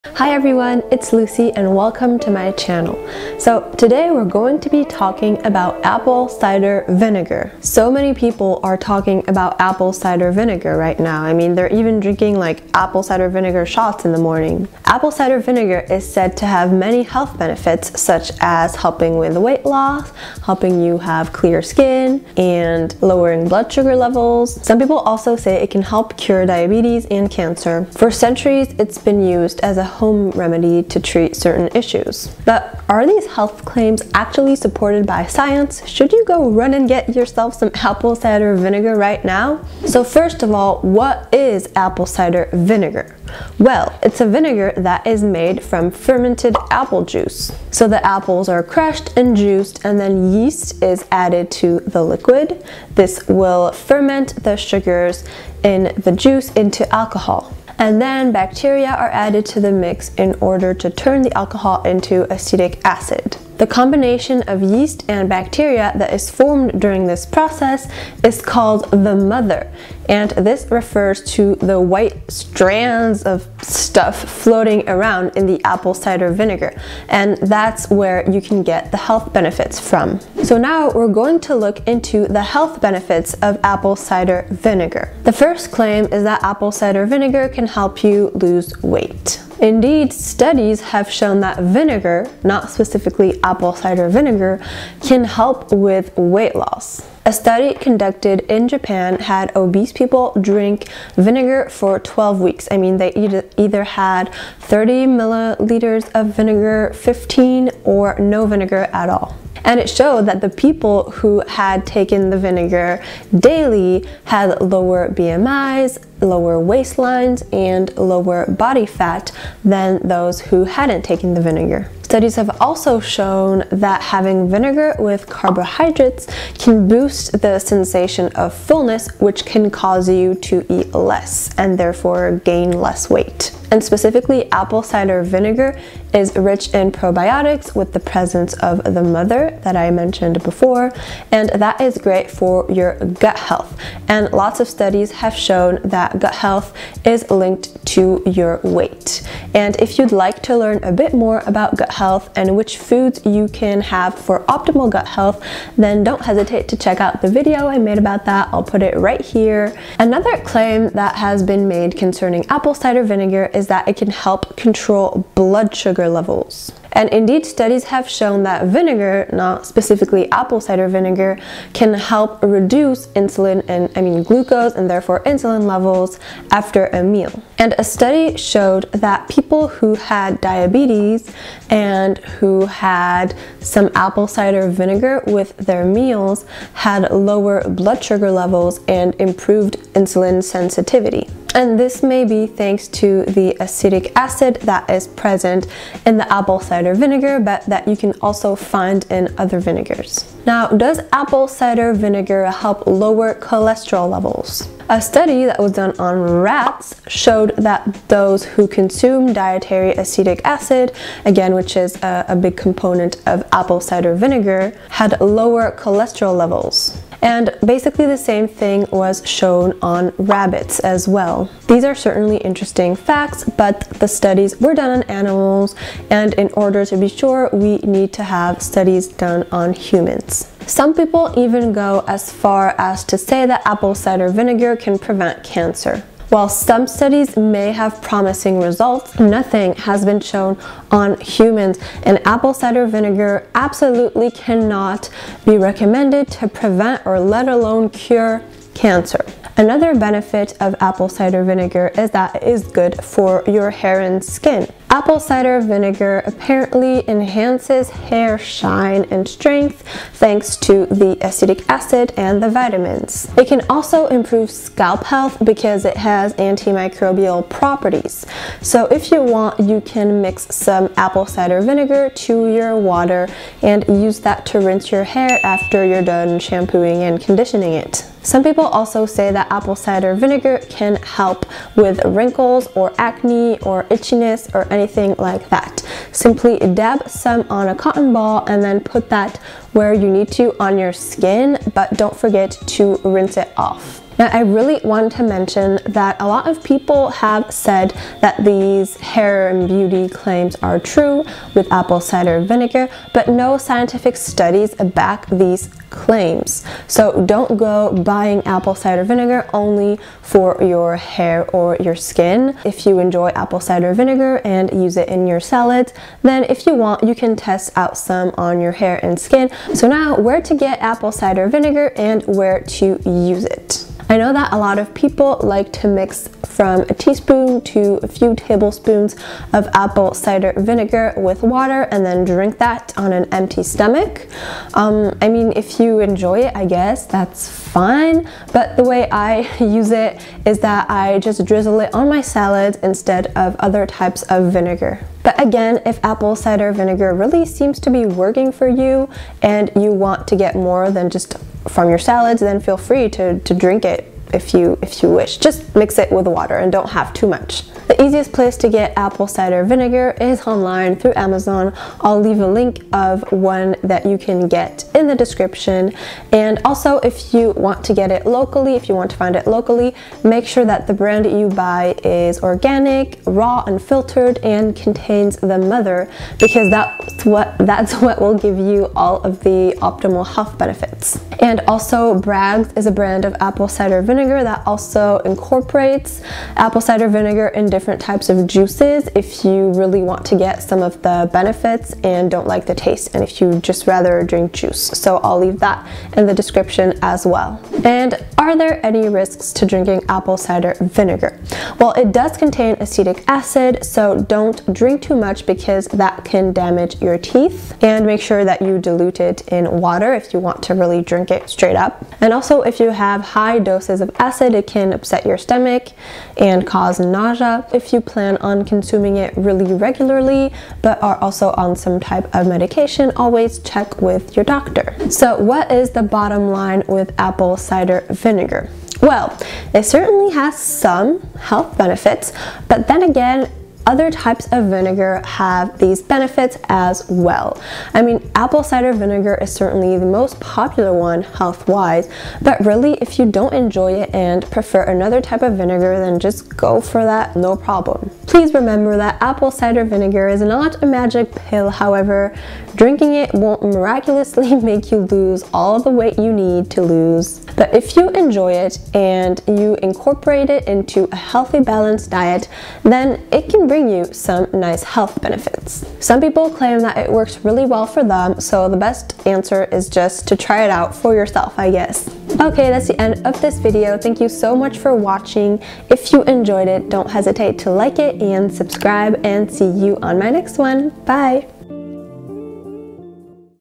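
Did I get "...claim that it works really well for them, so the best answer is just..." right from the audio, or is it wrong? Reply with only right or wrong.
right.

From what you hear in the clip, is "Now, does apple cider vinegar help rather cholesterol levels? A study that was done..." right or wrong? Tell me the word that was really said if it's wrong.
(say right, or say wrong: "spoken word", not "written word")
wrong: "lower", not "rather".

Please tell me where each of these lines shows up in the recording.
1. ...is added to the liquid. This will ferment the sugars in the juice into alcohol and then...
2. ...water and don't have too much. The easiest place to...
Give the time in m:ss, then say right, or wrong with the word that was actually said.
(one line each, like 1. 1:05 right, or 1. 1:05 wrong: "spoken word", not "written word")
1. 0:50 right
2. 5:56 right.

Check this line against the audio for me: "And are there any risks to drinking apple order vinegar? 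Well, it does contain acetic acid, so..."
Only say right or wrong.
wrong.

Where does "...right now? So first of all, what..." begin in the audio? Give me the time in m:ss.
0:38.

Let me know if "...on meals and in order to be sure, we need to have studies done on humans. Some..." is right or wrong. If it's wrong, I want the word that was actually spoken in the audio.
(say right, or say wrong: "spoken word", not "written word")
wrong: "animals", not "meals".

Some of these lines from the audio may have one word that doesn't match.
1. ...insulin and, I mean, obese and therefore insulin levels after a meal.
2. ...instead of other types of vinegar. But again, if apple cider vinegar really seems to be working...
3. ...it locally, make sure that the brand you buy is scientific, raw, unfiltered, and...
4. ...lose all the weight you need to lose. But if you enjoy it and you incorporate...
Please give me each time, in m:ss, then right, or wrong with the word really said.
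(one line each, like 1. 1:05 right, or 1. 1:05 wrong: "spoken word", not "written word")
1. 2:53 wrong: "glucose", not "obese"
2. 5:42 right
3. 6:09 wrong: "organic", not "scientific"
4. 7:35 right.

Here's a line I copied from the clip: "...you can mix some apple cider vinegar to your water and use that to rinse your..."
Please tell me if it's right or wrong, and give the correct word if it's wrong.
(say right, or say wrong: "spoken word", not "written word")
right.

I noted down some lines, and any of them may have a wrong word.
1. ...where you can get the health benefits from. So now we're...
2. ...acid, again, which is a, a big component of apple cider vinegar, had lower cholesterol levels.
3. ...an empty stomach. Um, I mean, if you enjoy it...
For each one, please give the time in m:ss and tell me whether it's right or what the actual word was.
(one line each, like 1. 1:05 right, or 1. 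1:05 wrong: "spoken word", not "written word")
1. 1:17 right
2. 3:30 right
3. 5:33 right.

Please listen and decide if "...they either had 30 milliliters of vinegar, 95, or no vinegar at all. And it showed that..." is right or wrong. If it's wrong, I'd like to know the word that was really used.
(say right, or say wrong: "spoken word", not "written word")
wrong: "15", not "95".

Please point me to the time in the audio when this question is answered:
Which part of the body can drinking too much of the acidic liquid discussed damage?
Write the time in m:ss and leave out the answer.
6:47.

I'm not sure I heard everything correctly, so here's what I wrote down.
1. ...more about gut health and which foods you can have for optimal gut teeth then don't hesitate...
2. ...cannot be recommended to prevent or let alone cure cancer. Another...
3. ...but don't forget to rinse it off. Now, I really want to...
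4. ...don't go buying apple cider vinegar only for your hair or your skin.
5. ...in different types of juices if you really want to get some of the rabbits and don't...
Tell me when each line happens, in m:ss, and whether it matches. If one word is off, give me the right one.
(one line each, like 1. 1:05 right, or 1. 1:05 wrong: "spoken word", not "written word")
1. 2:31 wrong: "health", not "teeth"
2. 4:04 right
3. 4:51 right
4. 5:07 right
5. 6:27 wrong: "benefits", not "rabbits".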